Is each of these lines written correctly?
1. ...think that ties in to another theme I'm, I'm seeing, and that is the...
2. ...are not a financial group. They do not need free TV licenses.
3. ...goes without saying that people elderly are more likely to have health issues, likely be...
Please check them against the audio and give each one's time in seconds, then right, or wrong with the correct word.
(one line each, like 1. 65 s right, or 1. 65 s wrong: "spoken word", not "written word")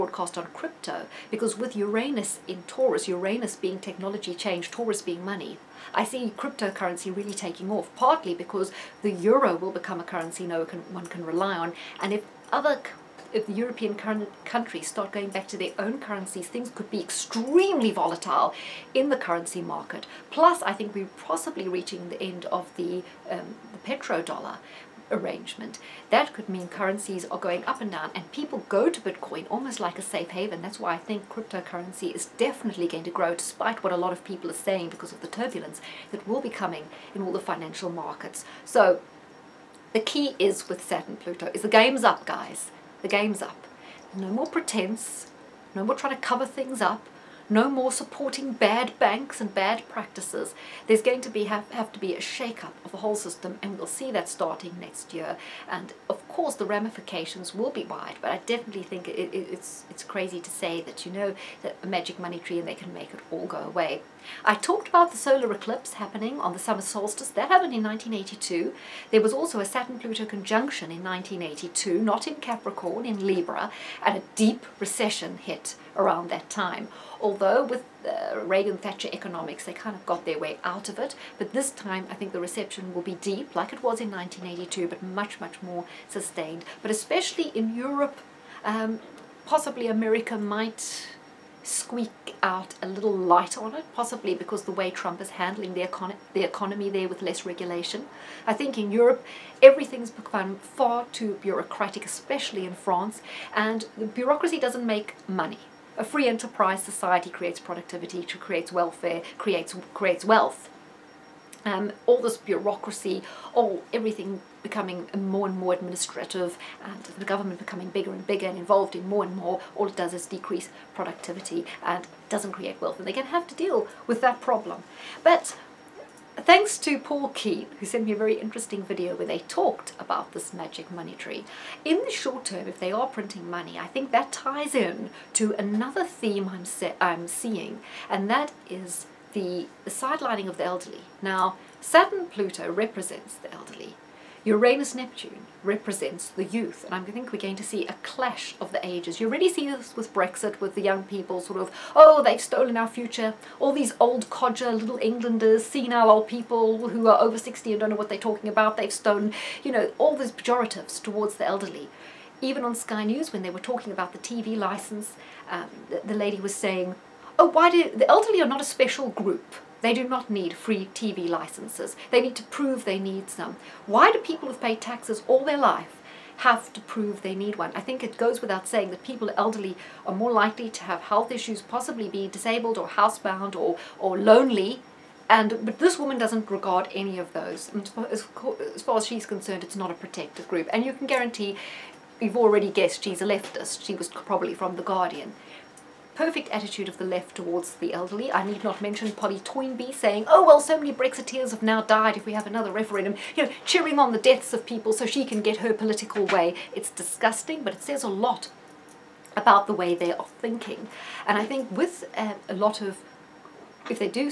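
1. 133 s right
2. 168 s wrong: "special", not "financial"
3. 178 s wrong: "possibly", not "likely".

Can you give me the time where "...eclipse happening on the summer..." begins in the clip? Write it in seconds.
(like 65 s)
65 s.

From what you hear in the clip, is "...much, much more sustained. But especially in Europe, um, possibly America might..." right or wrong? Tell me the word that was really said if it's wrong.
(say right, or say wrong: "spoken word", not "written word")
right.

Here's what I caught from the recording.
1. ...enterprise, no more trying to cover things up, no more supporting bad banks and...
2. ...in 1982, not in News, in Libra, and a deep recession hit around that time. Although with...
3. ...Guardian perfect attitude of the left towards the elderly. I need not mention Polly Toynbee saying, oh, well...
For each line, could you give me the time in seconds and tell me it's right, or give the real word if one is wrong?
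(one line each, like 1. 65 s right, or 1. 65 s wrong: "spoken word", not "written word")
1. 44 s wrong: "pretense", not "enterprise"
2. 70 s wrong: "Capricorn", not "News"
3. 194 s right.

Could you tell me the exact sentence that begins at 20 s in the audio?
Plus, I think we're possibly reaching the end of the, um, the petrodollar arrangement.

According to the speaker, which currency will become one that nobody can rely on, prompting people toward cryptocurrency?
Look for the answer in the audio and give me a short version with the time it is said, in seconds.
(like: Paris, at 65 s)
euro, at 9 s.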